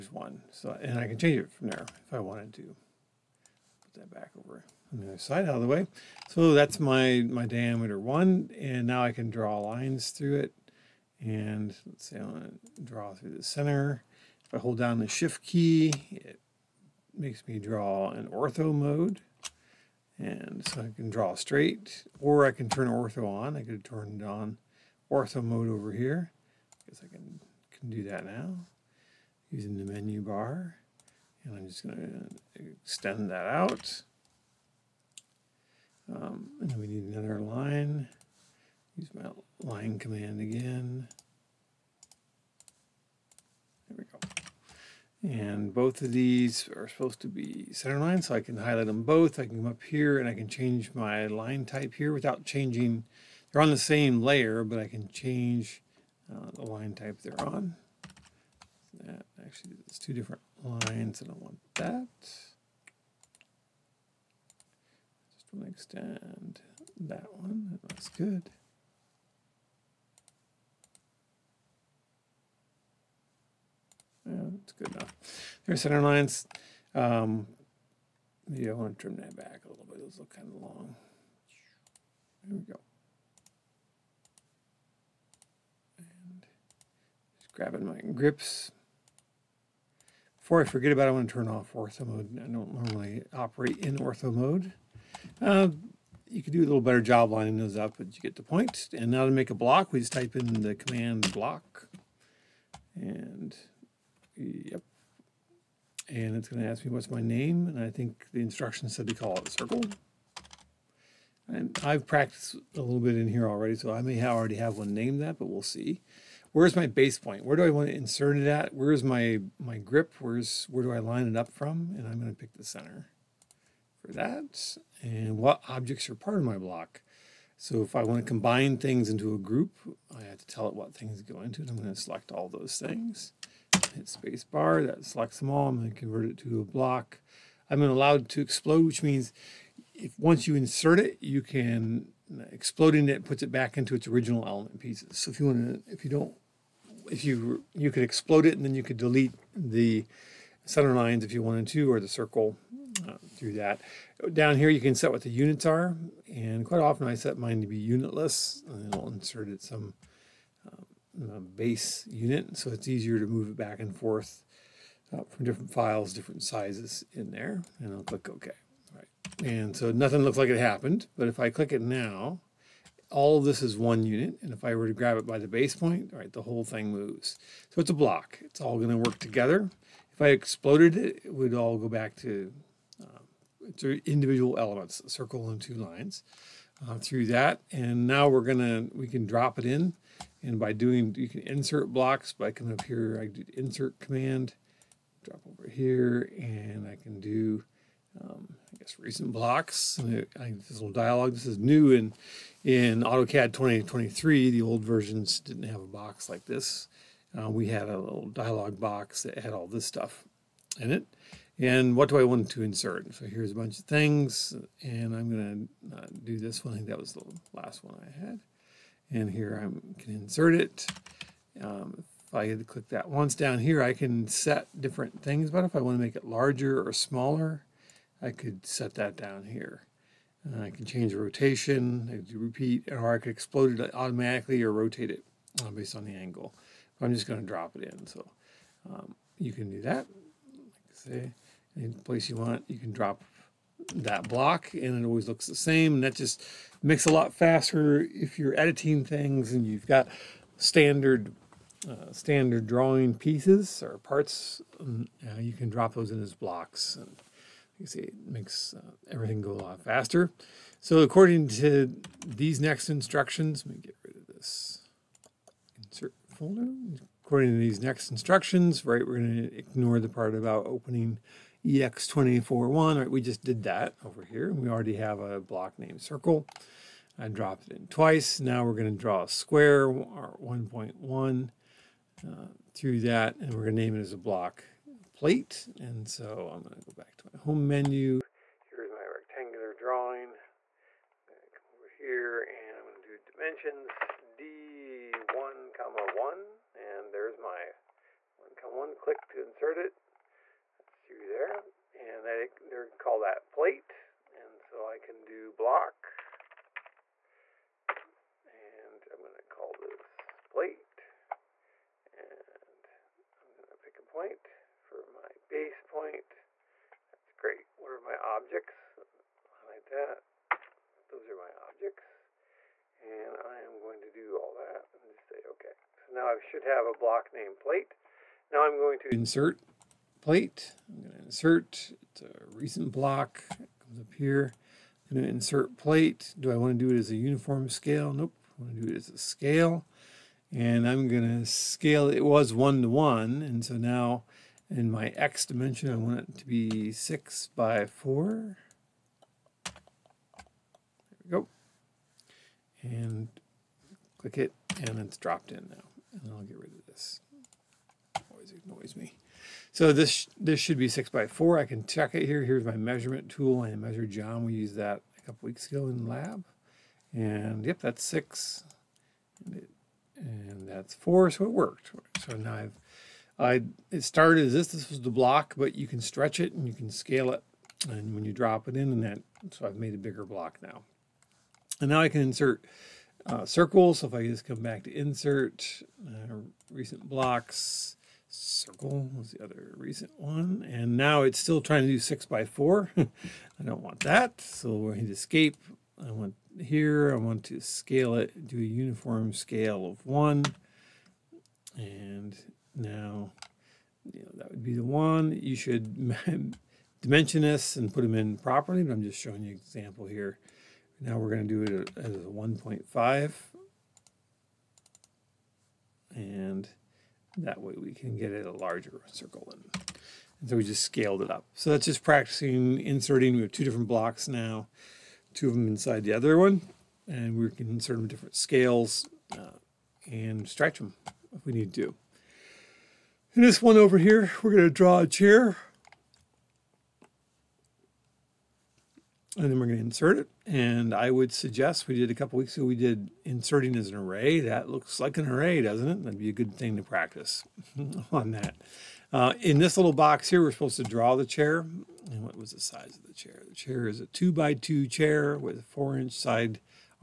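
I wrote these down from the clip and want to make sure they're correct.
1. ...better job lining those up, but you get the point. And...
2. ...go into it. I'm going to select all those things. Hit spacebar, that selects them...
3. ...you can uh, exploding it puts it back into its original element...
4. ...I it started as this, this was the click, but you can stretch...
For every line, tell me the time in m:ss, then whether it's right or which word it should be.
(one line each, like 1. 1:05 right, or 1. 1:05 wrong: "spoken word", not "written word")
1. 1:36 right
2. 2:11 right
3. 2:21 right
4. 6:13 wrong: "block", not "click".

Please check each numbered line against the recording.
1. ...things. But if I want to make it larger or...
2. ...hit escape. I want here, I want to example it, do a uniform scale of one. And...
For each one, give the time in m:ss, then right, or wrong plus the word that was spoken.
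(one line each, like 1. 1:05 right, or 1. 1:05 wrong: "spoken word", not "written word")
1. 3:45 right
2. 6:34 wrong: "scale", not "example".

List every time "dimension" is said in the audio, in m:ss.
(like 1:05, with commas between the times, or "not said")
4:53, 5:45, 6:47.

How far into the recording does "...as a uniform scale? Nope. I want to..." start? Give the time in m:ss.
5:36.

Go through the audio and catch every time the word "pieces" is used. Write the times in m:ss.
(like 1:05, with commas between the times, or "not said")
2:24, 4:13.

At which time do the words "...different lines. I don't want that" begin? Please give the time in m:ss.
1:00.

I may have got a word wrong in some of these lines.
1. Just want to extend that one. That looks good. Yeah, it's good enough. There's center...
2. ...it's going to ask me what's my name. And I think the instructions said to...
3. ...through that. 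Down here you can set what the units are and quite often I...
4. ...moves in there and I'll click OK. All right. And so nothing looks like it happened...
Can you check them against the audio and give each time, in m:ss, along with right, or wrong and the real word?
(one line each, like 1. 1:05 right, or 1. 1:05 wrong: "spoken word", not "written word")
1. 1:05 right
2. 1:46 right
3. 2:33 right
4. 2:46 wrong: "sizes", not "moves".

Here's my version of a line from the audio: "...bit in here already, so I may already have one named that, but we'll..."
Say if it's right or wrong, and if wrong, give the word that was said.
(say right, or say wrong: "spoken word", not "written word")
right.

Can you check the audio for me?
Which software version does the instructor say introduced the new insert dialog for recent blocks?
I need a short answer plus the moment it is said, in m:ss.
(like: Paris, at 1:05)
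AutoCAD 2023, at 3:23.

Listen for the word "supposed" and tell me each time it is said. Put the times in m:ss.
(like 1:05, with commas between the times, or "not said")
0:46, 7:30.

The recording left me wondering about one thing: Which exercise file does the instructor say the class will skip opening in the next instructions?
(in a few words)
EX241.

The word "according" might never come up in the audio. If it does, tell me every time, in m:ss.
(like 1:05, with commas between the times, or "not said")
4:20, 4:27.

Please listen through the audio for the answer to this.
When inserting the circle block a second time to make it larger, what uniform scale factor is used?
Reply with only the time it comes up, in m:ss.
6:52.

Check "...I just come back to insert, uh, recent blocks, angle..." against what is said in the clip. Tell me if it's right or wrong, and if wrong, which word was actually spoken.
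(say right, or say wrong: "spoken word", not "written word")
wrong: "circle", not "angle".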